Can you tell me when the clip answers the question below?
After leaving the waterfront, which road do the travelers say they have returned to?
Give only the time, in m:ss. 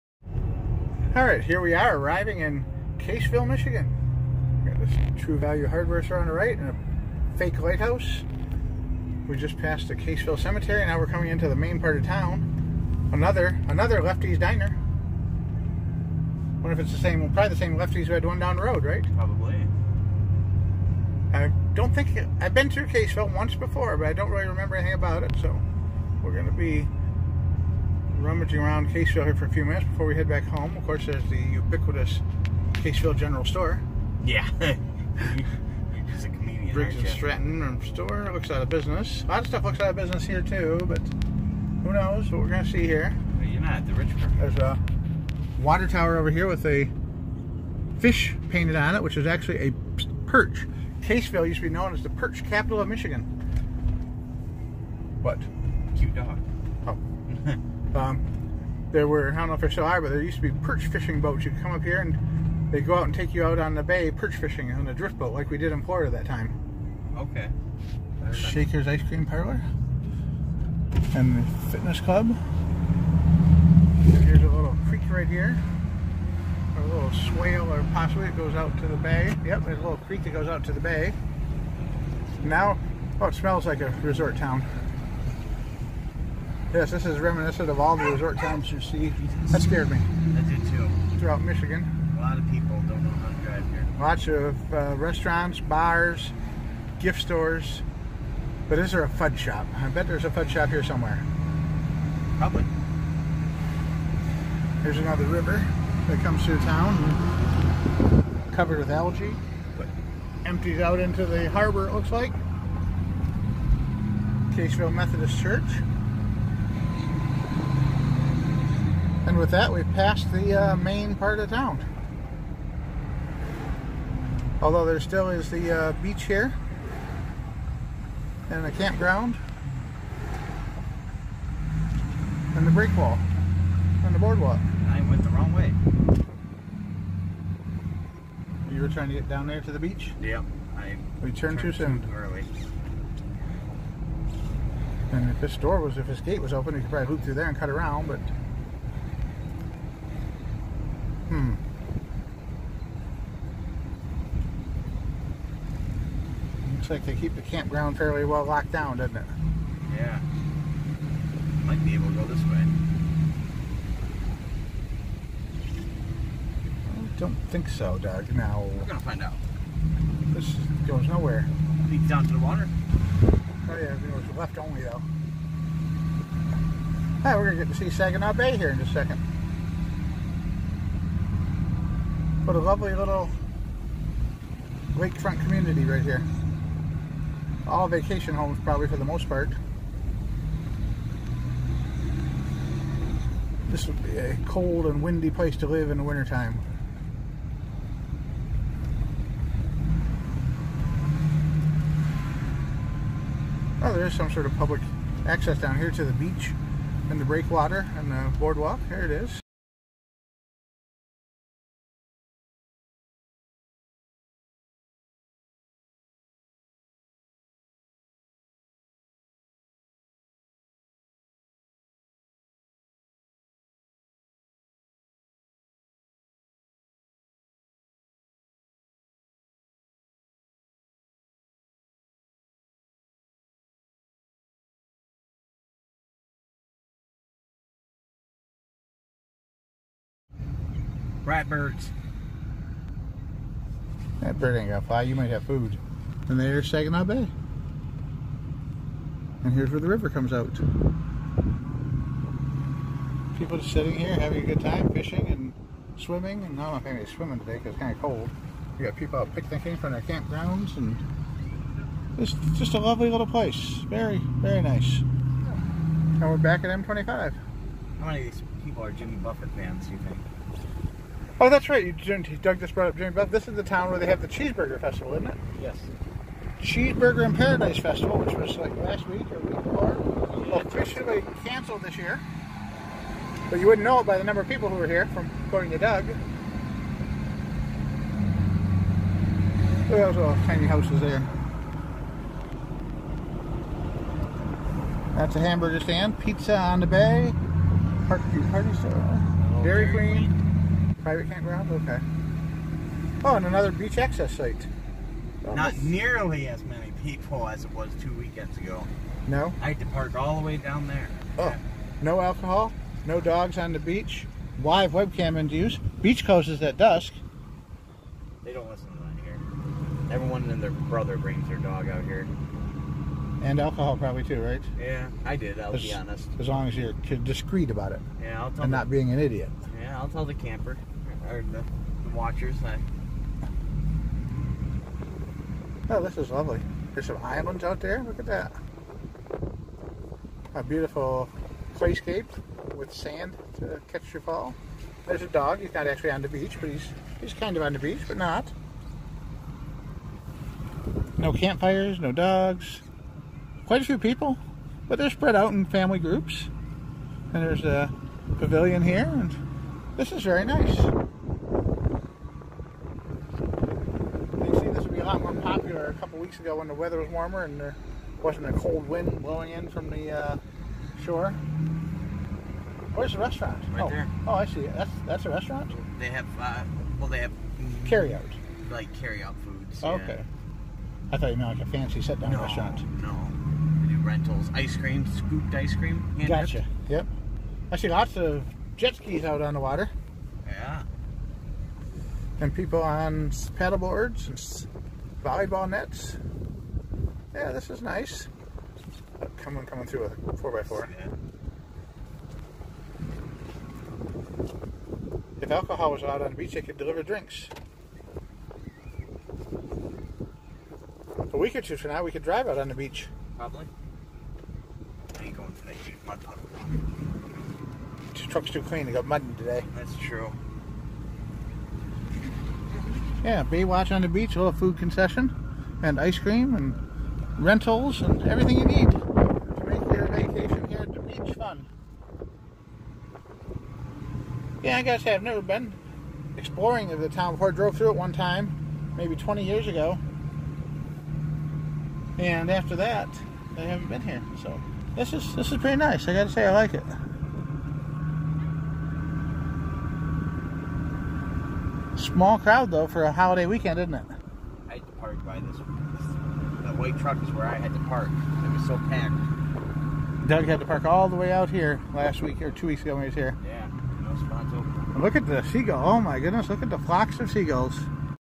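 4:26.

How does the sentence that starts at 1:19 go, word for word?
Yep, there's a little creek that goes out to the bay.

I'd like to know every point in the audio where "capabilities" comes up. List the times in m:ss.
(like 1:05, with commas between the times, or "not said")
not said.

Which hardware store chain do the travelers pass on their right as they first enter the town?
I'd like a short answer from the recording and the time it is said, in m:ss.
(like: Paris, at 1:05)
True Value, at 0:05.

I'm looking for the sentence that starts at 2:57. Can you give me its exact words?
Hey, ah, we're gonna get to see Saginaw Bay here in just a second.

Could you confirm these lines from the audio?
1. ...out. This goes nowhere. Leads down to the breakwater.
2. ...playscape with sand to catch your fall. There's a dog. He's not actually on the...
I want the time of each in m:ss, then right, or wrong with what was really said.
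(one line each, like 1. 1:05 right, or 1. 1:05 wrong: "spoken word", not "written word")
1. 2:49 wrong: "water", not "breakwater"
2. 5:41 right.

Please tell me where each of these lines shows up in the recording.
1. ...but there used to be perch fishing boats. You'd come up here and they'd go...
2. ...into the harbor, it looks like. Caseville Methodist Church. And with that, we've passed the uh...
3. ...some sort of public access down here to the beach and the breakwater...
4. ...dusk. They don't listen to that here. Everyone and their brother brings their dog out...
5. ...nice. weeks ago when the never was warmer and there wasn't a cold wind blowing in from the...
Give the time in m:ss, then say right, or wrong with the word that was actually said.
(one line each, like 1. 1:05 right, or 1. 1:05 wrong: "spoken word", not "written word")
1. 1:00 right
2. 1:51 right
3. 3:24 right
4. 5:16 right
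5. 6:00 wrong: "weather", not "never".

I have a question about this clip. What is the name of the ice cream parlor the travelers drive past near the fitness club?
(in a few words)
Shaker's.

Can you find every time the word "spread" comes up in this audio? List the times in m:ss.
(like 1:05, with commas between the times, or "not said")
5:55.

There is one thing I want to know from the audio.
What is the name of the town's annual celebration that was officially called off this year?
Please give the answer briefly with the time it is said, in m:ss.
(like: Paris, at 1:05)
Cheeseburger in Paradise Festival, at 4:36.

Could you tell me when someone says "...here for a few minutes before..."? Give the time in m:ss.
0:29.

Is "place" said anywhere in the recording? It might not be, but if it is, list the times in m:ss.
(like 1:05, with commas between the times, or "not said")
3:15, 4:23.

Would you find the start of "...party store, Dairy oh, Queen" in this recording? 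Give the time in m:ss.
4:58.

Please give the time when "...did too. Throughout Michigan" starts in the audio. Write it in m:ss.
1:30.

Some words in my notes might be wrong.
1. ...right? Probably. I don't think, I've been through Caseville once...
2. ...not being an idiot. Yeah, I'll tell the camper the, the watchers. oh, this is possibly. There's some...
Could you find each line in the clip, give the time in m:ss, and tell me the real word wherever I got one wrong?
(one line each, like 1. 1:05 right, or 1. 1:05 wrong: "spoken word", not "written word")
1. 0:18 right
2. 5:28 wrong: "lovely", not "possibly".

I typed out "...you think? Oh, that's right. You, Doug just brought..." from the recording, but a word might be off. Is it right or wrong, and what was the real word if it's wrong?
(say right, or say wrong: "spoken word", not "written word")
right.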